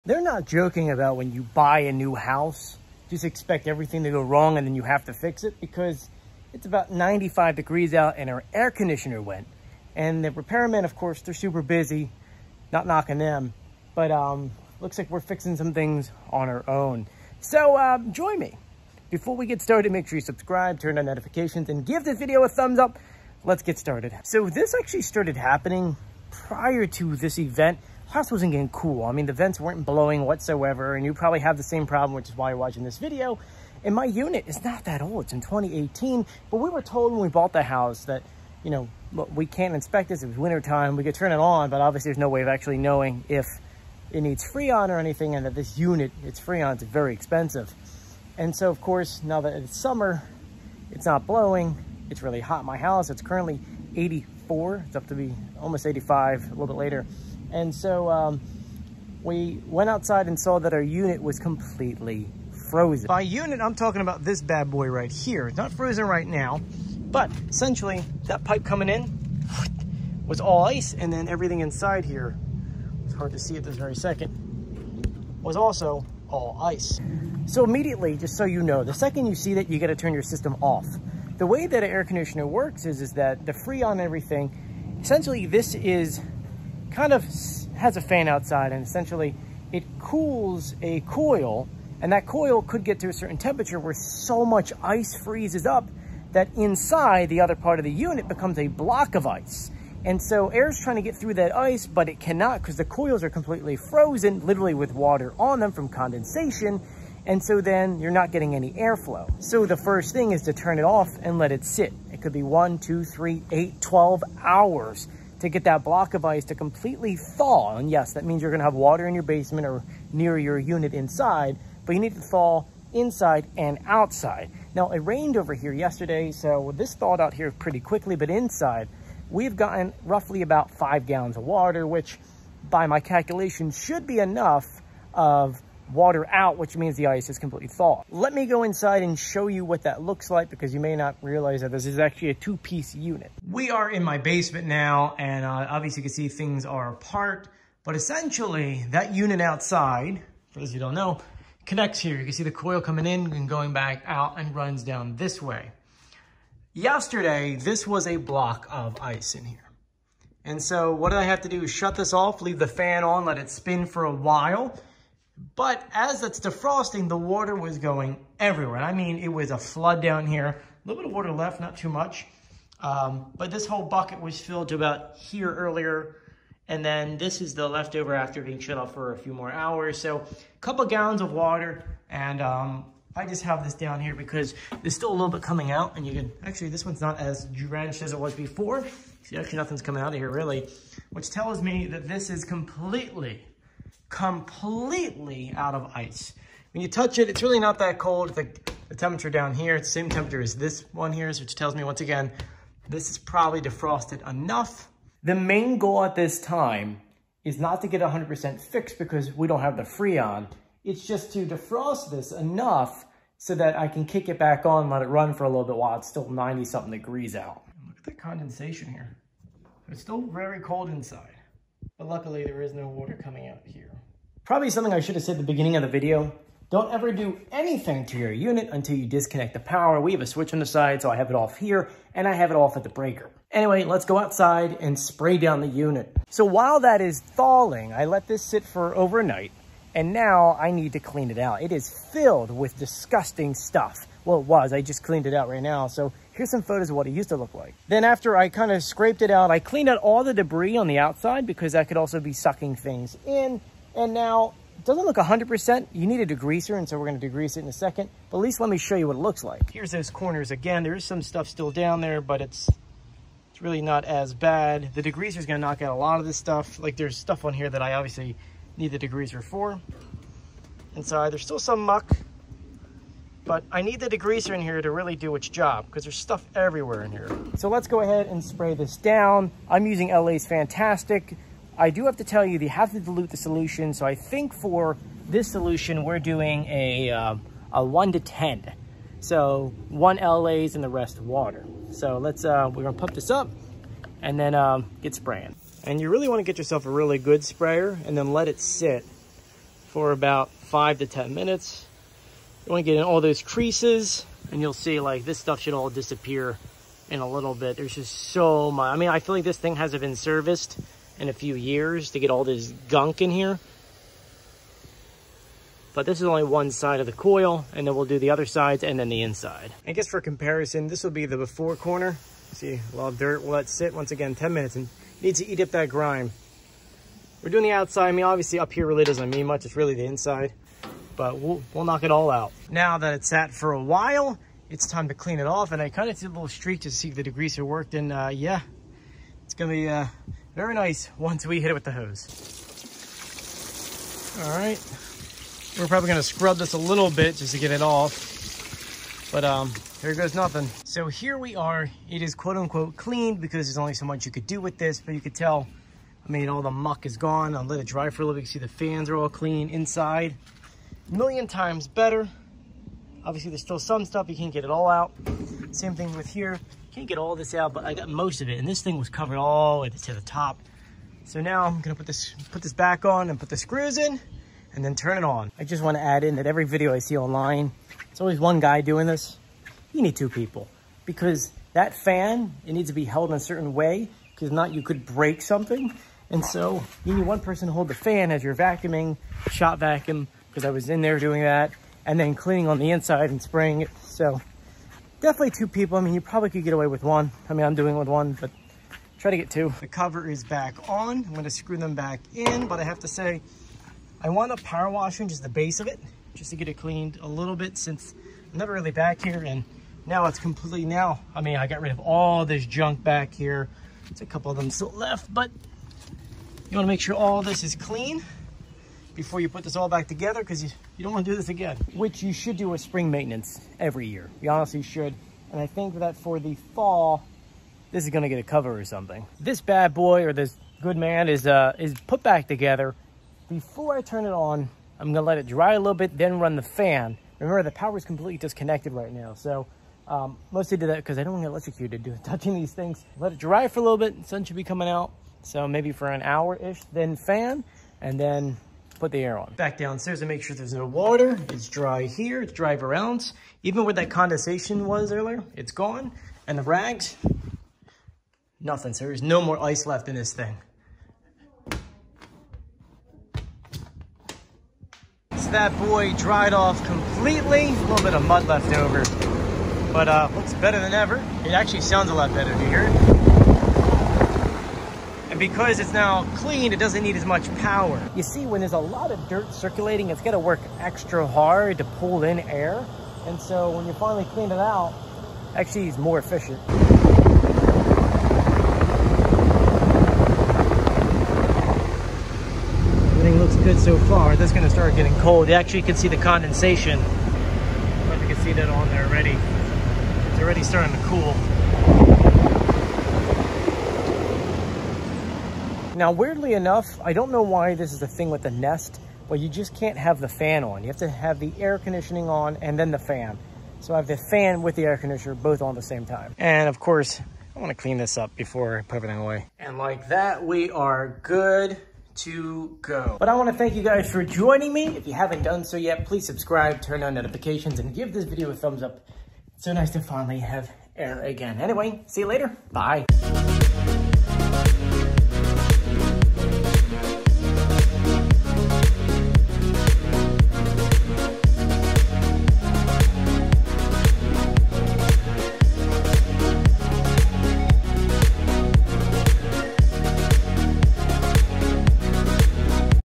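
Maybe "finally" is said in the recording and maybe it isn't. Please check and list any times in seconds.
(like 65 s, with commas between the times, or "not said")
483 s, 530 s.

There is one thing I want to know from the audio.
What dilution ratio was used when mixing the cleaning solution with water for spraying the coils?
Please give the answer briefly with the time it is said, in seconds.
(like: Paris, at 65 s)
1 to 10, at 287 s.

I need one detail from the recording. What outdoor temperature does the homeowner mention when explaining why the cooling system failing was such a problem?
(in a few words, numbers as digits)
95 degrees.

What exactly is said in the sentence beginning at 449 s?
Back downstairs to make sure there's no water.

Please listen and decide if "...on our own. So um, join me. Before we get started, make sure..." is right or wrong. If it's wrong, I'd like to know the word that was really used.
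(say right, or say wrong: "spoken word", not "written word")
right.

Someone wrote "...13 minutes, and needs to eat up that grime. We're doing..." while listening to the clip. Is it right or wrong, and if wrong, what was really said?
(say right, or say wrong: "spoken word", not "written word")
wrong: "10", not "13".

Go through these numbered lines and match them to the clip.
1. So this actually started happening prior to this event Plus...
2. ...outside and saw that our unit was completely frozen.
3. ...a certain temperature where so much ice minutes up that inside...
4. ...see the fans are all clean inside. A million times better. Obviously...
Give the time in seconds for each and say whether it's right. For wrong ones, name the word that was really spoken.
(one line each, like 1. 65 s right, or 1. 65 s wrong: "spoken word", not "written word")
1. 24 s right
2. 59 s right
3. 93 s wrong: "freezes", not "minutes"
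4. 358 s right.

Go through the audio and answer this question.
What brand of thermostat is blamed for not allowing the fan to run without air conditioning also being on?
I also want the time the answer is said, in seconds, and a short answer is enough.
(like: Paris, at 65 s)
Nest, at 508 s.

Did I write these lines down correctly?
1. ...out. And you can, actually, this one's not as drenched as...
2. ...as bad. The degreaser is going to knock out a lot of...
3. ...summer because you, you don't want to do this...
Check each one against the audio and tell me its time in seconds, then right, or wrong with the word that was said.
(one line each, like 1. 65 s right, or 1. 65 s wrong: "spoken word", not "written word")
1. 185 s right
2. 264 s right
3. 420 s wrong: "together", not "summer".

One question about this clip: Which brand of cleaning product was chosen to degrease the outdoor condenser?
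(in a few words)
LA's Fantastic.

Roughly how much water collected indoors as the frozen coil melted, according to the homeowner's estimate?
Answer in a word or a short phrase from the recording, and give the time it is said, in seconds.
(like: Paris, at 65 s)
5 gallons, at 130 s.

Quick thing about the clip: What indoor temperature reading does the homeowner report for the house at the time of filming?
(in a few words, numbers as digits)
84.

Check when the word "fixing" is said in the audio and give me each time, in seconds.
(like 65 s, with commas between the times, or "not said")
15 s.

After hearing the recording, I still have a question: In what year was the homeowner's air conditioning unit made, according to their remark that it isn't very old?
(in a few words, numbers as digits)
2018.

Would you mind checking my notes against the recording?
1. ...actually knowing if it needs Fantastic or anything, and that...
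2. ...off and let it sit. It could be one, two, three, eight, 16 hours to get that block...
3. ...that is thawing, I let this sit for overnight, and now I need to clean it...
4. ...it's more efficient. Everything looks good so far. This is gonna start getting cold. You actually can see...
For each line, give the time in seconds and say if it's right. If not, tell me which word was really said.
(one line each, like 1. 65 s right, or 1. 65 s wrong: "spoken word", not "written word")
1. 42 s wrong: "Freon", not "Fantastic"
2. 110 s wrong: "12", not "16"
3. 236 s right
4. 485 s right.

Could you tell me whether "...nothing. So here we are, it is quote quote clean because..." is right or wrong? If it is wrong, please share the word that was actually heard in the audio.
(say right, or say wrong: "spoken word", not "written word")
wrong: "unquote", not "quote".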